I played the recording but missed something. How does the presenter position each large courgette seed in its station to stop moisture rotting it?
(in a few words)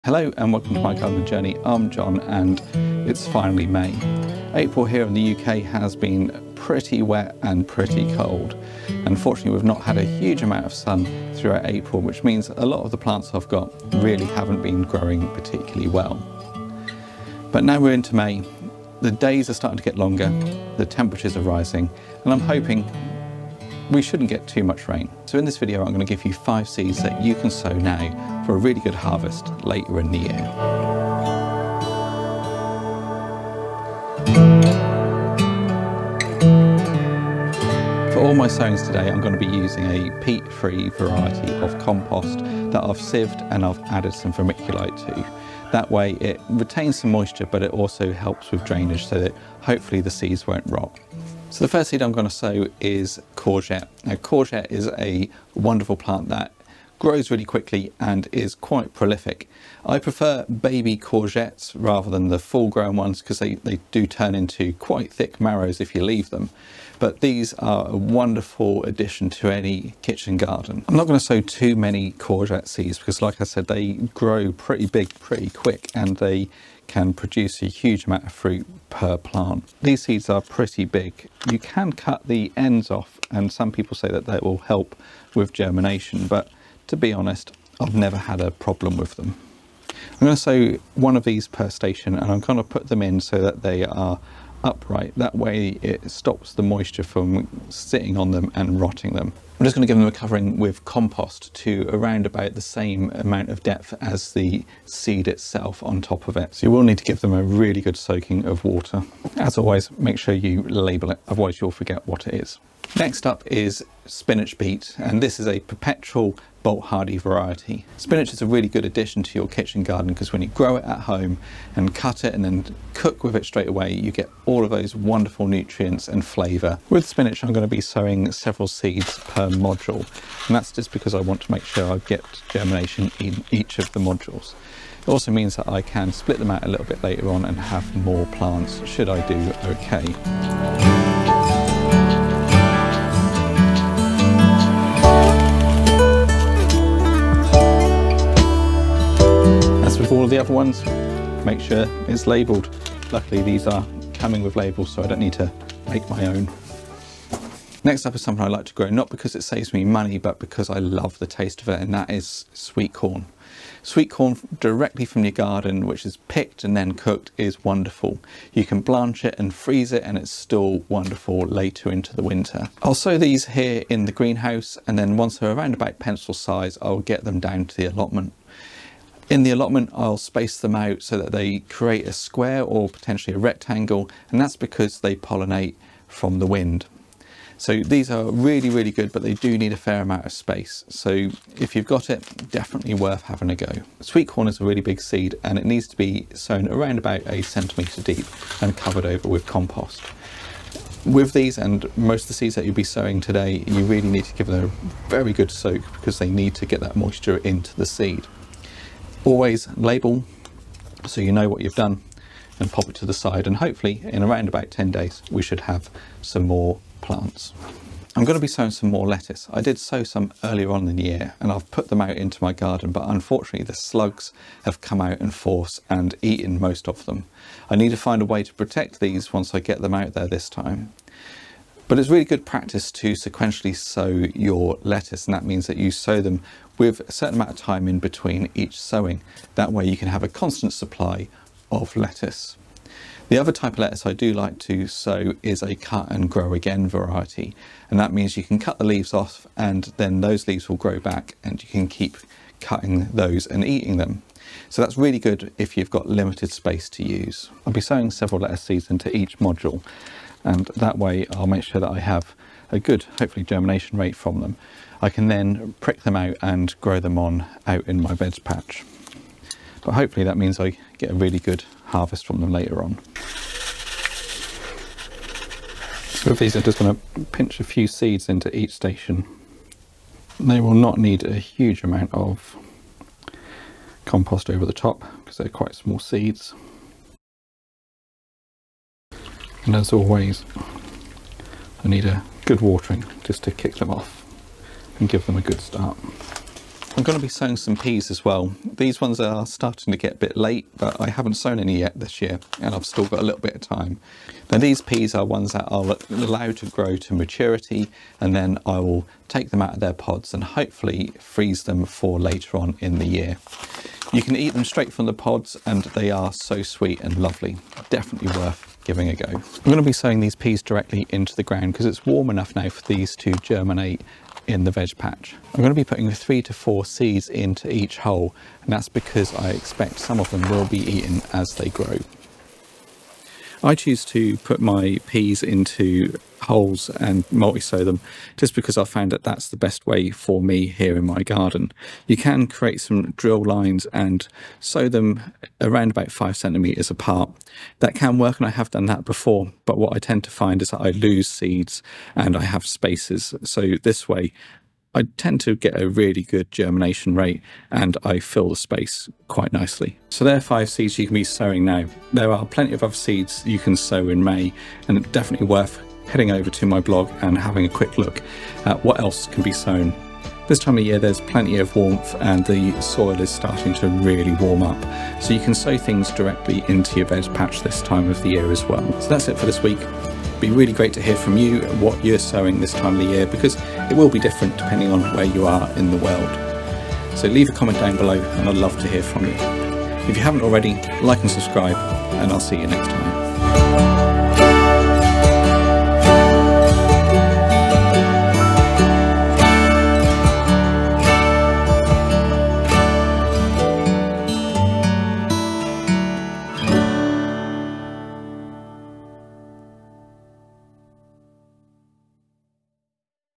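Upright.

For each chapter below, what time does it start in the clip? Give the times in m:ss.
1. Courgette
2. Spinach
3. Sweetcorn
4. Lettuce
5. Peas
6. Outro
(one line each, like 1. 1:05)
1. 0:52
2. 1:53
3. 2:43
4. 3:40
5. 4:57
6. 6:00.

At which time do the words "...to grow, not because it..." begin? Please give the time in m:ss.
2:38.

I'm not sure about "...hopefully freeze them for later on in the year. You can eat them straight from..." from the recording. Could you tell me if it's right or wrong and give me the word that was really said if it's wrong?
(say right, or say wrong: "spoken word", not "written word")
right.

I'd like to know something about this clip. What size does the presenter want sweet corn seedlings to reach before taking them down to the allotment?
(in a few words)
Pencil size.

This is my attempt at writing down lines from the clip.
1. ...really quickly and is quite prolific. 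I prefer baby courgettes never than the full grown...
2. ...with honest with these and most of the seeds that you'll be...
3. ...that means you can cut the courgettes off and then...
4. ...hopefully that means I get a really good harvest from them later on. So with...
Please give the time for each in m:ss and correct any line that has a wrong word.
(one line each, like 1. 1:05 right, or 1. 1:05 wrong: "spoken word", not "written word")
1. 0:57 wrong: "rather", not "never"
2. 3:19 wrong: "compost", not "honest"
3. 4:07 wrong: "leaves", not "courgettes"
4. 4:29 right.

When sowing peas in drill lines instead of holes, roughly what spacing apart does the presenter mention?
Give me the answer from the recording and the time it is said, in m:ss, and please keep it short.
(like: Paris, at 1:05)
5 centimetres, at 5:46.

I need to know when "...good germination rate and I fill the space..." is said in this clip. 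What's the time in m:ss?
5:56.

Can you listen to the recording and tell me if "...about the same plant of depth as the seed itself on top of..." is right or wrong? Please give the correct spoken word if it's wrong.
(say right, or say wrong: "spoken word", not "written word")
wrong: "amount", not "plant".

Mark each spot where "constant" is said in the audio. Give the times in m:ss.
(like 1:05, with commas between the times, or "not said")
4:00.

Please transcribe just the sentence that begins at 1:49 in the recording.
As always, make sure you label it, otherwise you'll forget what it is.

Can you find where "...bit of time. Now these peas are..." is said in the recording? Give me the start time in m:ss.
5:03.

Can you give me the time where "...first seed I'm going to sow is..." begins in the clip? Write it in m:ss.
0:51.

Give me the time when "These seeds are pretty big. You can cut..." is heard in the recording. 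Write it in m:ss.
1:19.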